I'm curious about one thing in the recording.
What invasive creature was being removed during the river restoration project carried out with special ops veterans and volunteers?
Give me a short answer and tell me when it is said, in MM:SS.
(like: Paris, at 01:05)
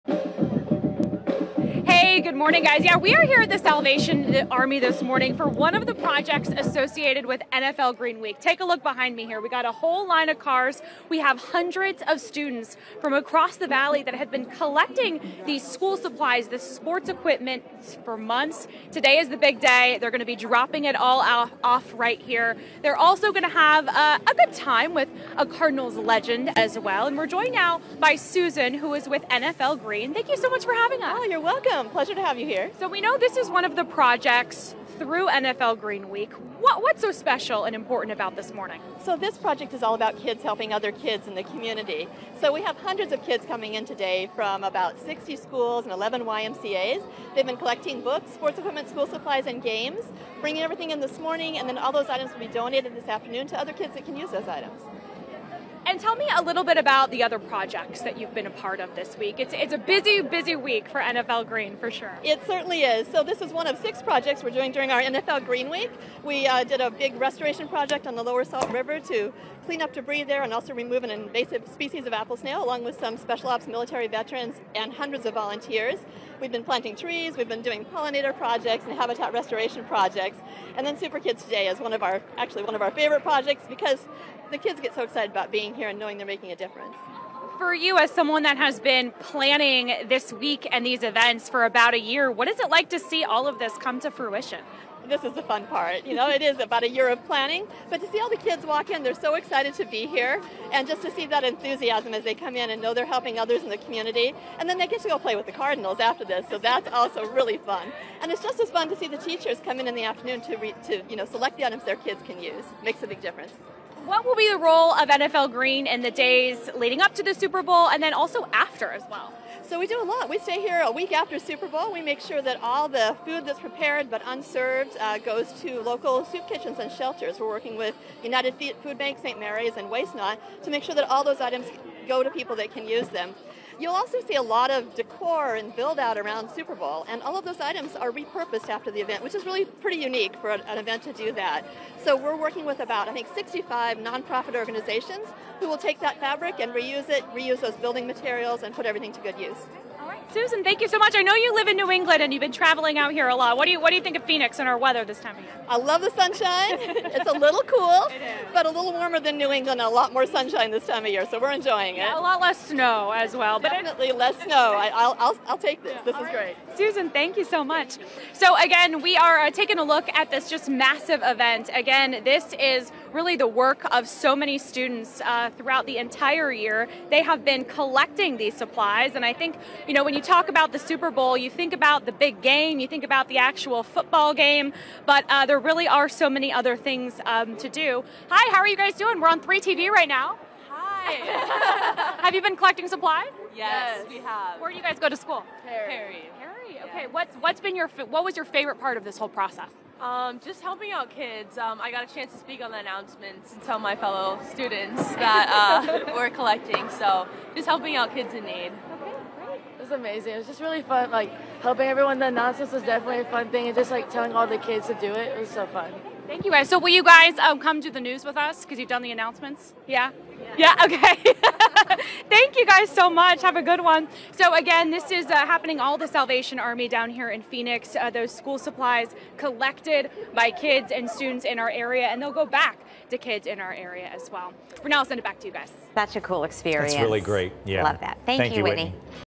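apple snail, at 01:12.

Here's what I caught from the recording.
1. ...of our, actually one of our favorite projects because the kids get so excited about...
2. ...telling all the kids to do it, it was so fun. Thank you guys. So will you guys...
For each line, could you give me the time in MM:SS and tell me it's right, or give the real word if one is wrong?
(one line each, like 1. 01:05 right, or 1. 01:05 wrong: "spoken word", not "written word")
1. 01:21 right
2. 03:34 right.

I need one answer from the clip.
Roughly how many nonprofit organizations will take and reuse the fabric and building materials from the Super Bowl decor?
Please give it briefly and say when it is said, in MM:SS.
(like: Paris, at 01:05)
65, at 02:23.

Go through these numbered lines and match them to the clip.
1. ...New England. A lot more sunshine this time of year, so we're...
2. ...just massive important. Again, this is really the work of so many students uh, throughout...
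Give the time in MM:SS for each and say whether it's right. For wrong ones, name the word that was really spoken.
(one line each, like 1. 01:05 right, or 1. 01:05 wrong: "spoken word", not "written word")
1. 02:39 right
2. 02:50 wrong: "event", not "important".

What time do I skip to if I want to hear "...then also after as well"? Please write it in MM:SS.
01:58.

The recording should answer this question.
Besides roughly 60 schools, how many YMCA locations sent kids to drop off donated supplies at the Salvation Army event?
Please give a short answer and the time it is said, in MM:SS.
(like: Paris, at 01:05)
11, at 00:45.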